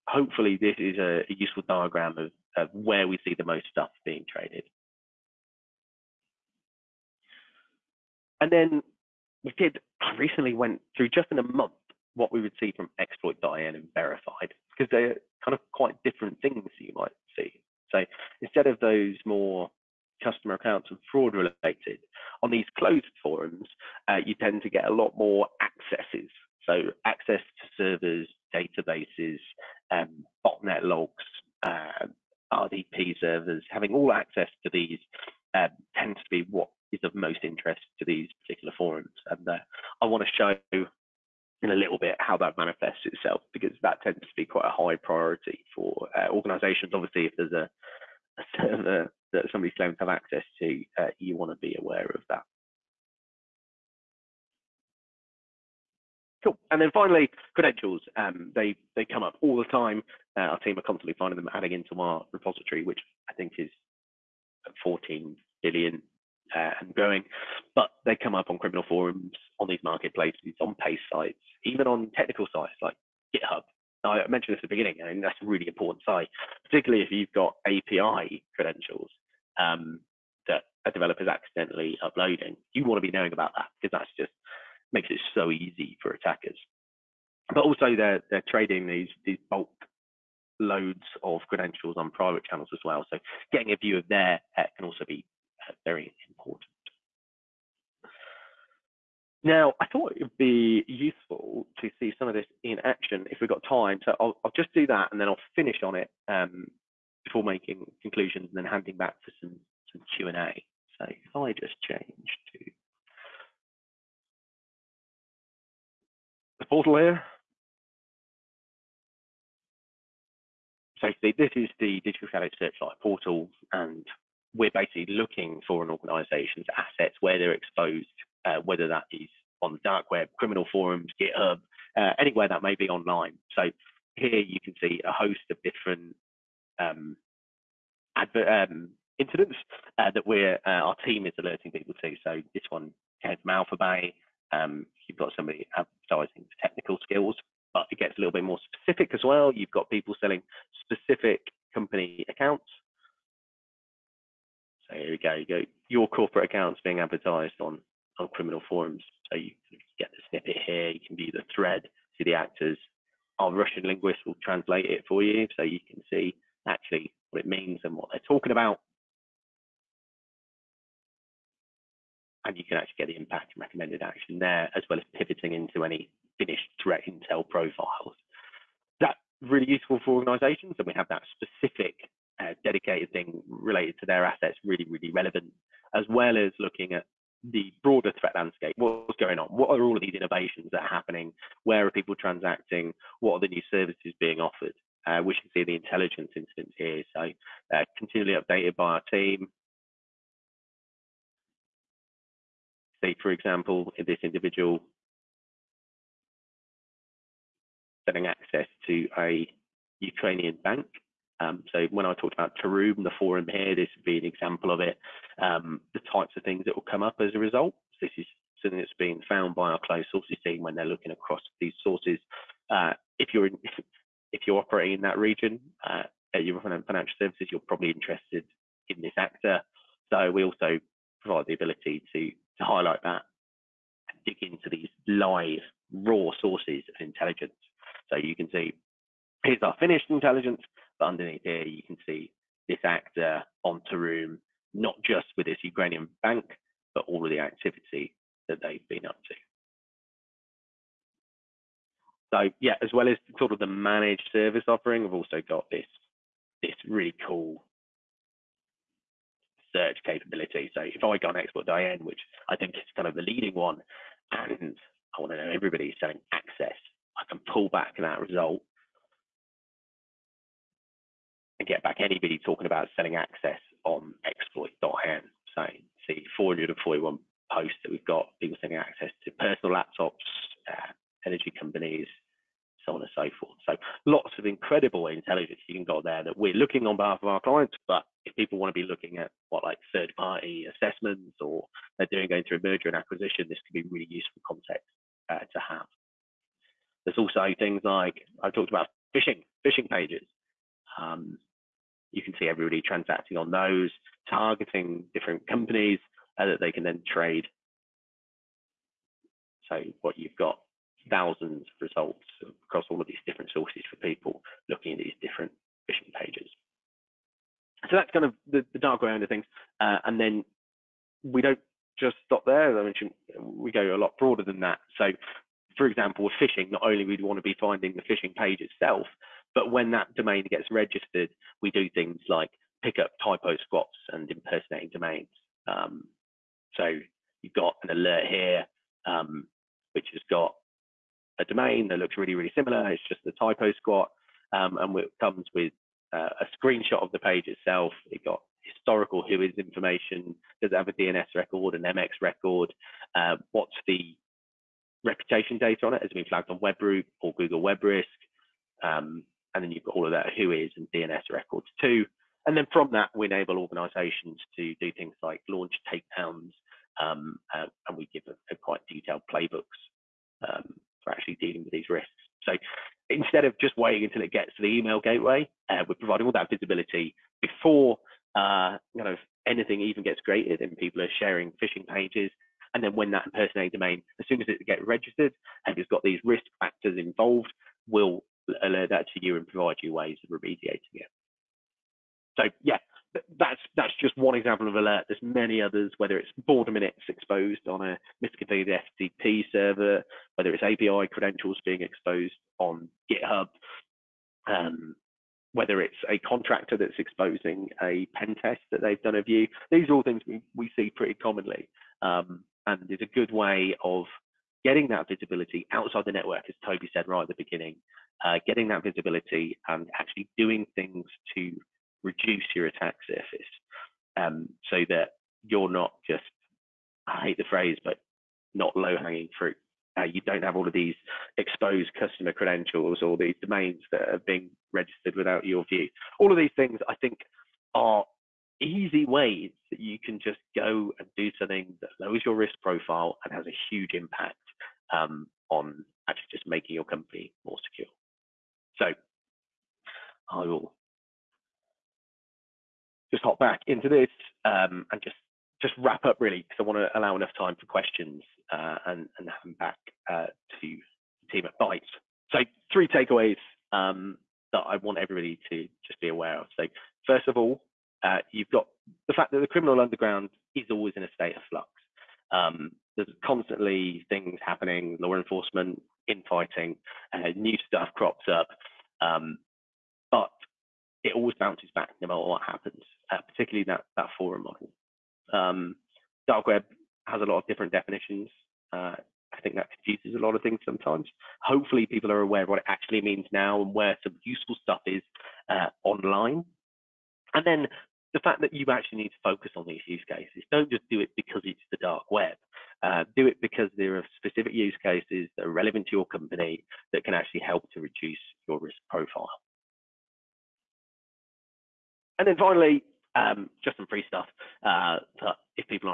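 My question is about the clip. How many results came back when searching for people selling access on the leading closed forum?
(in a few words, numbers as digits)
441.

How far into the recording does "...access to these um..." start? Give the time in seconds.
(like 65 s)
34 s.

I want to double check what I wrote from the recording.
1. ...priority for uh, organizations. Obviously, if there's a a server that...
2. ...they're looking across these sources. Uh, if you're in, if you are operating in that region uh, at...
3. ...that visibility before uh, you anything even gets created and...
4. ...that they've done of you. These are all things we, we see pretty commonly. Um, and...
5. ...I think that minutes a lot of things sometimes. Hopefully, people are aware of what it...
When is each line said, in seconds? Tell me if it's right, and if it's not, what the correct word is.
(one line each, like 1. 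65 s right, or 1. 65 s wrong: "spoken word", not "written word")
1. 44 s right
2. 220 s right
3. 376 s right
4. 408 s right
5. 489 s wrong: "confuses", not "minutes".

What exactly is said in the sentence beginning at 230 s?
So we also provide the ability to, to highlight that and dig into these live, raw sources of intelligence.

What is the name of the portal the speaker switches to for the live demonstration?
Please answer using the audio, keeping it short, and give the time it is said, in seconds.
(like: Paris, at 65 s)
Digital Shadow Searchlight, at 122 s.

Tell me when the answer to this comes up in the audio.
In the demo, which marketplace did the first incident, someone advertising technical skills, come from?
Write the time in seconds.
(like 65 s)
143 s.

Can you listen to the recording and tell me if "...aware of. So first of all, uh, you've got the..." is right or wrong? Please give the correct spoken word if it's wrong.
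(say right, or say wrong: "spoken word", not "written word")
right.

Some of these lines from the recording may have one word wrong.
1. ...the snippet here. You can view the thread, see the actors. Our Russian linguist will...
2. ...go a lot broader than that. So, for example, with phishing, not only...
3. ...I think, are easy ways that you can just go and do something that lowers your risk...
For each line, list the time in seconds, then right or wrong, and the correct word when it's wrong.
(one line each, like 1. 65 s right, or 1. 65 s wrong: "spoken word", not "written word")
1. 160 s right
2. 323 s right
3. 436 s right.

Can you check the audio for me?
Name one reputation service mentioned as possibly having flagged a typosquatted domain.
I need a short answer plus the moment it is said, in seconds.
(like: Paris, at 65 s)
WebRoot, at 356 s.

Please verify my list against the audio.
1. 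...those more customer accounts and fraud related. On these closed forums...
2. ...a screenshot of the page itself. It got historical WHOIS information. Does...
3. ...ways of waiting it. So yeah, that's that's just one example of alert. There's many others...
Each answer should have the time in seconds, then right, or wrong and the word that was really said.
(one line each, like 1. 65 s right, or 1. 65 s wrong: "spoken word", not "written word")
1. 18 s right
2. 346 s right
3. 389 s wrong: "remediating", not "waiting".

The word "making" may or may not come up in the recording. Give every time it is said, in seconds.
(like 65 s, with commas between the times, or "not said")
107 s, 446 s.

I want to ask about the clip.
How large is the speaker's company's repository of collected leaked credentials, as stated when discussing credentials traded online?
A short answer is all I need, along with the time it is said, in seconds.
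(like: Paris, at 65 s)
14 billion, at 64 s.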